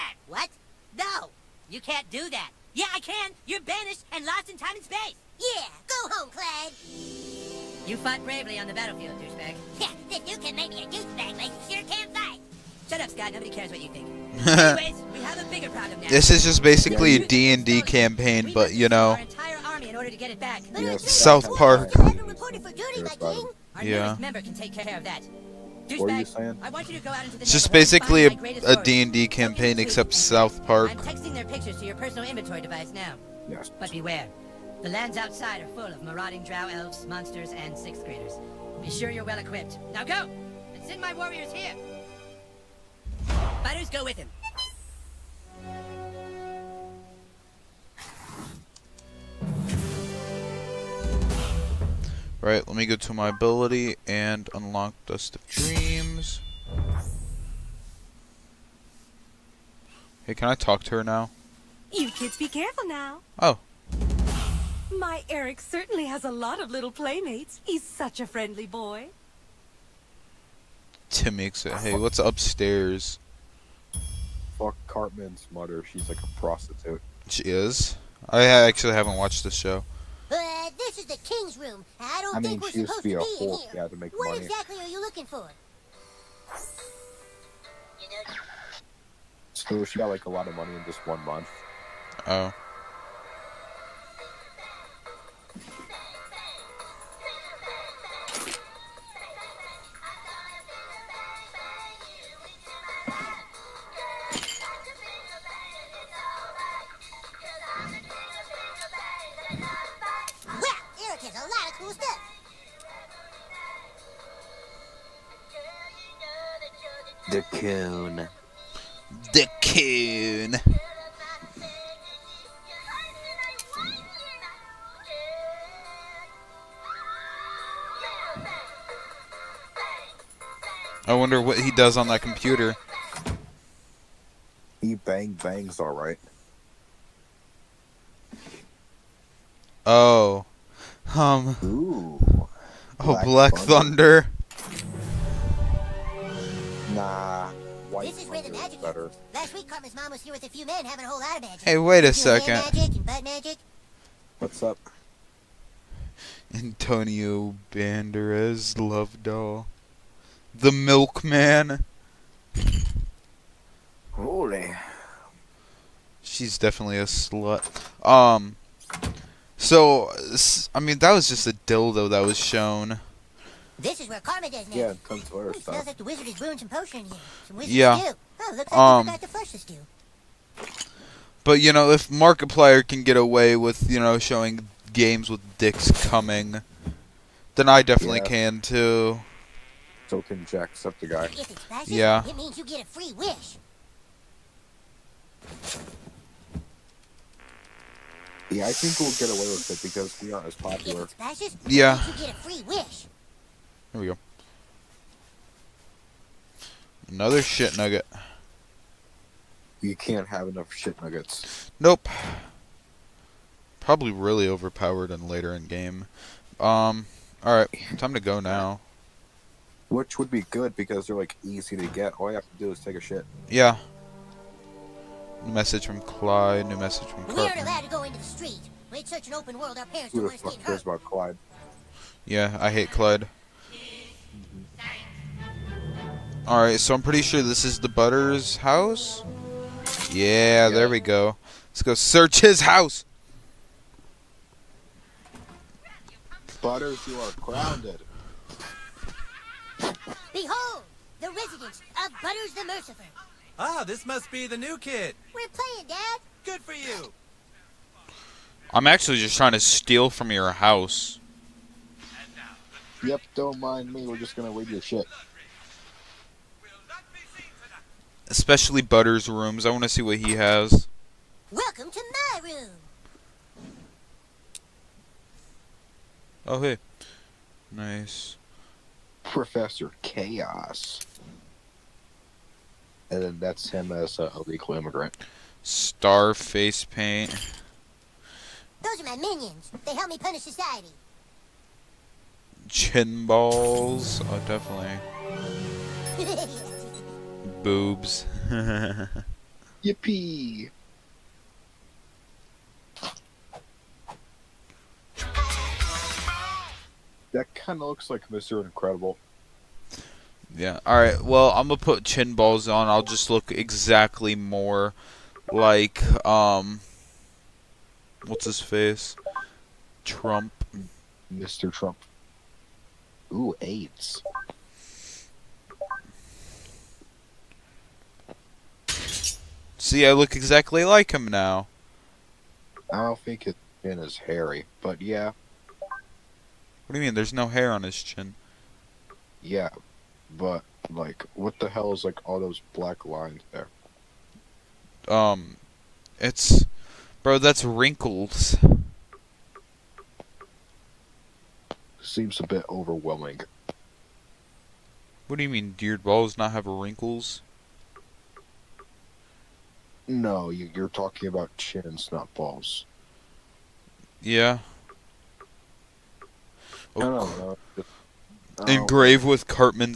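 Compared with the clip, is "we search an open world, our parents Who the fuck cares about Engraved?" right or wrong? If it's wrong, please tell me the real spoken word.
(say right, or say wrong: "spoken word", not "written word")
wrong: "Clyde", not "Engraved".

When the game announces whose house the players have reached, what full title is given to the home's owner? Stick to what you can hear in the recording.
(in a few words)
Butters the Merciful.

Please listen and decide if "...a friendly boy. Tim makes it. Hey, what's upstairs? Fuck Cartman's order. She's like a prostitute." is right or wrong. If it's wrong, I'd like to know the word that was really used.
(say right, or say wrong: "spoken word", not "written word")
wrong: "mother", not "order".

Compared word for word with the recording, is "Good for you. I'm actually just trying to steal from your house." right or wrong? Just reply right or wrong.
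right.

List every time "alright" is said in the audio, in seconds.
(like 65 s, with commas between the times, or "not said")
135 s, 217 s, 236 s.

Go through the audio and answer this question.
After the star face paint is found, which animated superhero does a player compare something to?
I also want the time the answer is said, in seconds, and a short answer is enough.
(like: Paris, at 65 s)
Mr. Incredible, at 308 s.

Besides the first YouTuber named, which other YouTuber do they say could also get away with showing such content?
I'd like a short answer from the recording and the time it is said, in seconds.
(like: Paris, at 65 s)
Jacksepticeye, at 190 s.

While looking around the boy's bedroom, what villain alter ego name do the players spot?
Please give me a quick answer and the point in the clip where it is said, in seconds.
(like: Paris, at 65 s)
Professor Chaos, at 279 s.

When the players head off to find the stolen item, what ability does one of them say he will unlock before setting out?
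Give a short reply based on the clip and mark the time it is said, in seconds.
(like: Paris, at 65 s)
Dust of Dreams, at 55 s.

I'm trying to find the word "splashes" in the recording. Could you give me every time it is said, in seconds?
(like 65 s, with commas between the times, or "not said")
191 s, 201 s.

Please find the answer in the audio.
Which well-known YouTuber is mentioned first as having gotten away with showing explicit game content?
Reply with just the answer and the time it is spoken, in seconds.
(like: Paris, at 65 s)
Markiplier, at 182 s.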